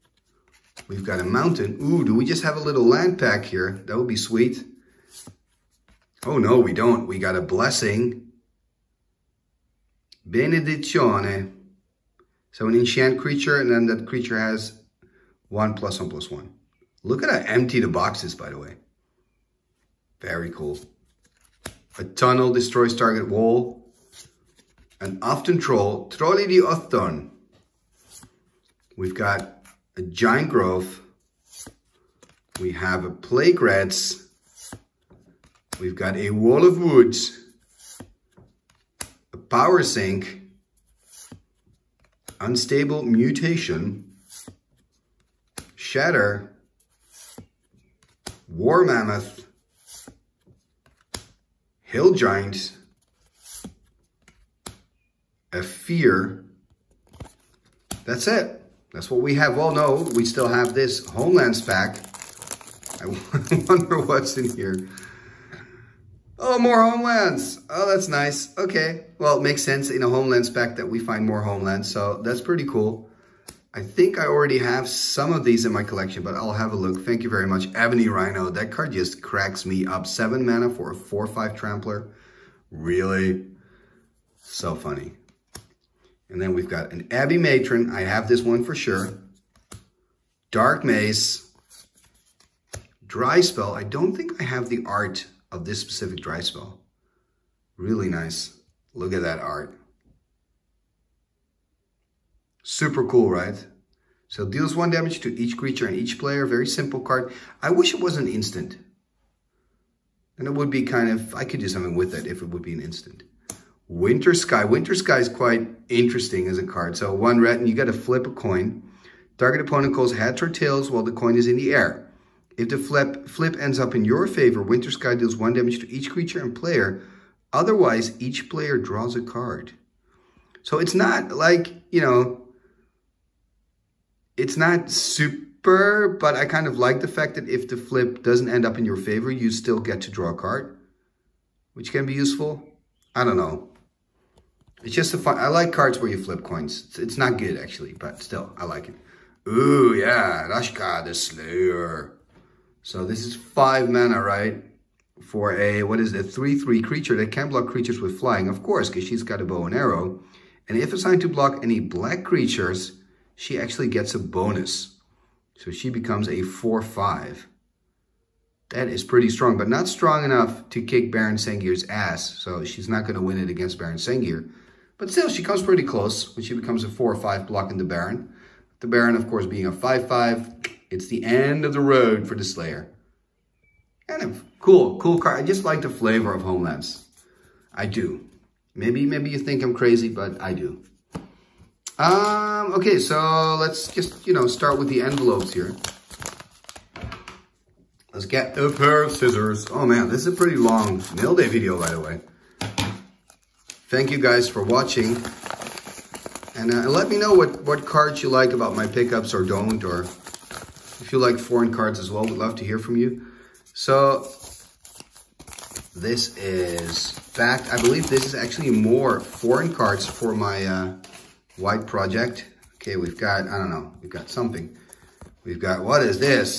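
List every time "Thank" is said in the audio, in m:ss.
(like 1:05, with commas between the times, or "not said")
1:17, 3:23.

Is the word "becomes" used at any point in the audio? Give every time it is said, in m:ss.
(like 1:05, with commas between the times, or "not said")
2:45, 2:56.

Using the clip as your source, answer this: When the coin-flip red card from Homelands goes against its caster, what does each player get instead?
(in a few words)
draws a card.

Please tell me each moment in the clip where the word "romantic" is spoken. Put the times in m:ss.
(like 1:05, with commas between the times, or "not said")
not said.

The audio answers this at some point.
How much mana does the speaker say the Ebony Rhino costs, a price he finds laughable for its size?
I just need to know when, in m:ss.
1:20.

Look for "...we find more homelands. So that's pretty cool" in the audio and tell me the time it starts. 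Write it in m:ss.
1:10.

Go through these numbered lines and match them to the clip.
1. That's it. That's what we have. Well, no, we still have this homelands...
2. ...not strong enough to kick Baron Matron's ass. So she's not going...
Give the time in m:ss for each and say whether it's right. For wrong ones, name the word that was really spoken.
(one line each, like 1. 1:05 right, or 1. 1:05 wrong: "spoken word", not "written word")
1. 0:58 right
2. 2:49 wrong: "Sengir", not "Matron".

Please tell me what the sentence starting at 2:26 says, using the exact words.
It's not good actually, but still, I like it.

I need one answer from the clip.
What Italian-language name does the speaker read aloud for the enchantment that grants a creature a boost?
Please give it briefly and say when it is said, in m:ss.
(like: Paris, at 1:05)
Benedizione, at 0:10.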